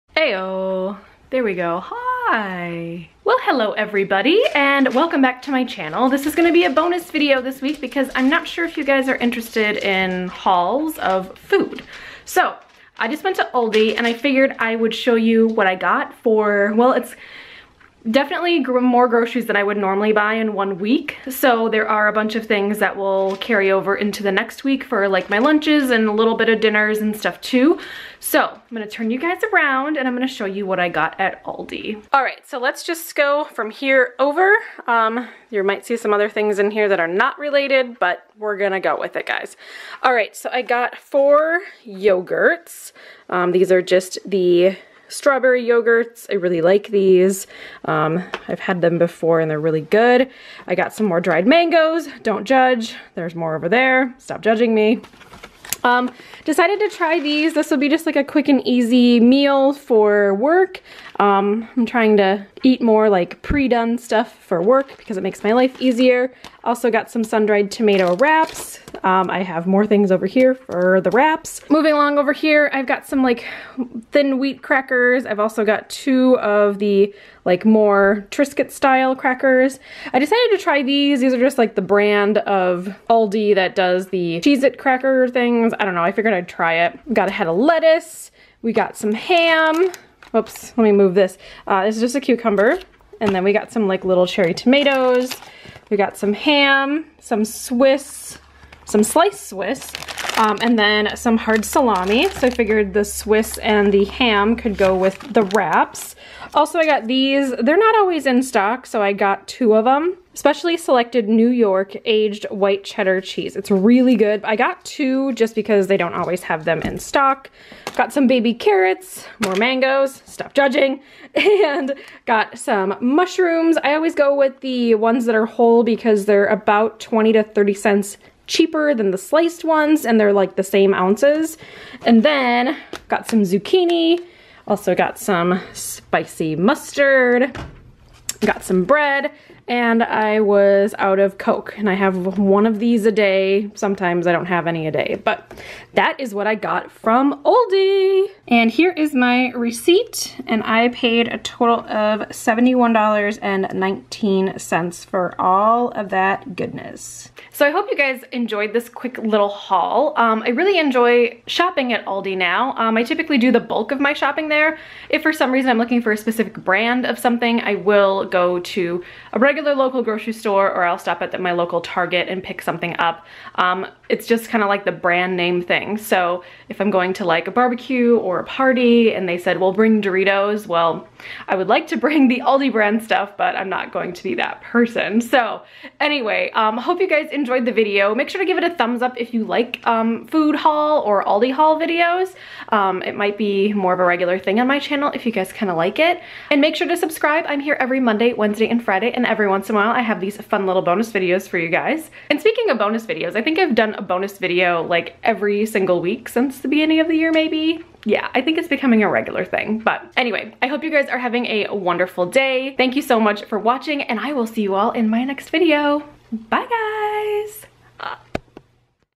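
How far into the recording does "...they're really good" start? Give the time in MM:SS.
00:49.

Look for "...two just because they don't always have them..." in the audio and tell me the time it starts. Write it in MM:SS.
01:54.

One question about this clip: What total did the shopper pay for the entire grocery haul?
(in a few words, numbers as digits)
$71.19.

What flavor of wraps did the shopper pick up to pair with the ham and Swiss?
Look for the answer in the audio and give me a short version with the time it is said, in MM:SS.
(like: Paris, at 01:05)
Sun-dried tomato, at 01:07.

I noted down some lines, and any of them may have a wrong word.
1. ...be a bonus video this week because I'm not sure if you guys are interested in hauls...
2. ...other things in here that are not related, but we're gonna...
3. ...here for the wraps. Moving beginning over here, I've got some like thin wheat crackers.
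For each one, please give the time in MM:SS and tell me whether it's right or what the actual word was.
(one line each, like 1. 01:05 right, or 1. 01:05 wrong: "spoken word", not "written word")
1. 00:06 right
2. 00:36 right
3. 01:10 wrong: "along", not "beginning".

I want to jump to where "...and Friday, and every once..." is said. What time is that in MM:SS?
03:18.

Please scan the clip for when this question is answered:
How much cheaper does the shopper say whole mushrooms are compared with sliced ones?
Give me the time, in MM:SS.
02:07.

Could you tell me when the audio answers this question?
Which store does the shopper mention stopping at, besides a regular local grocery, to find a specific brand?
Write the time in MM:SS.
02:51.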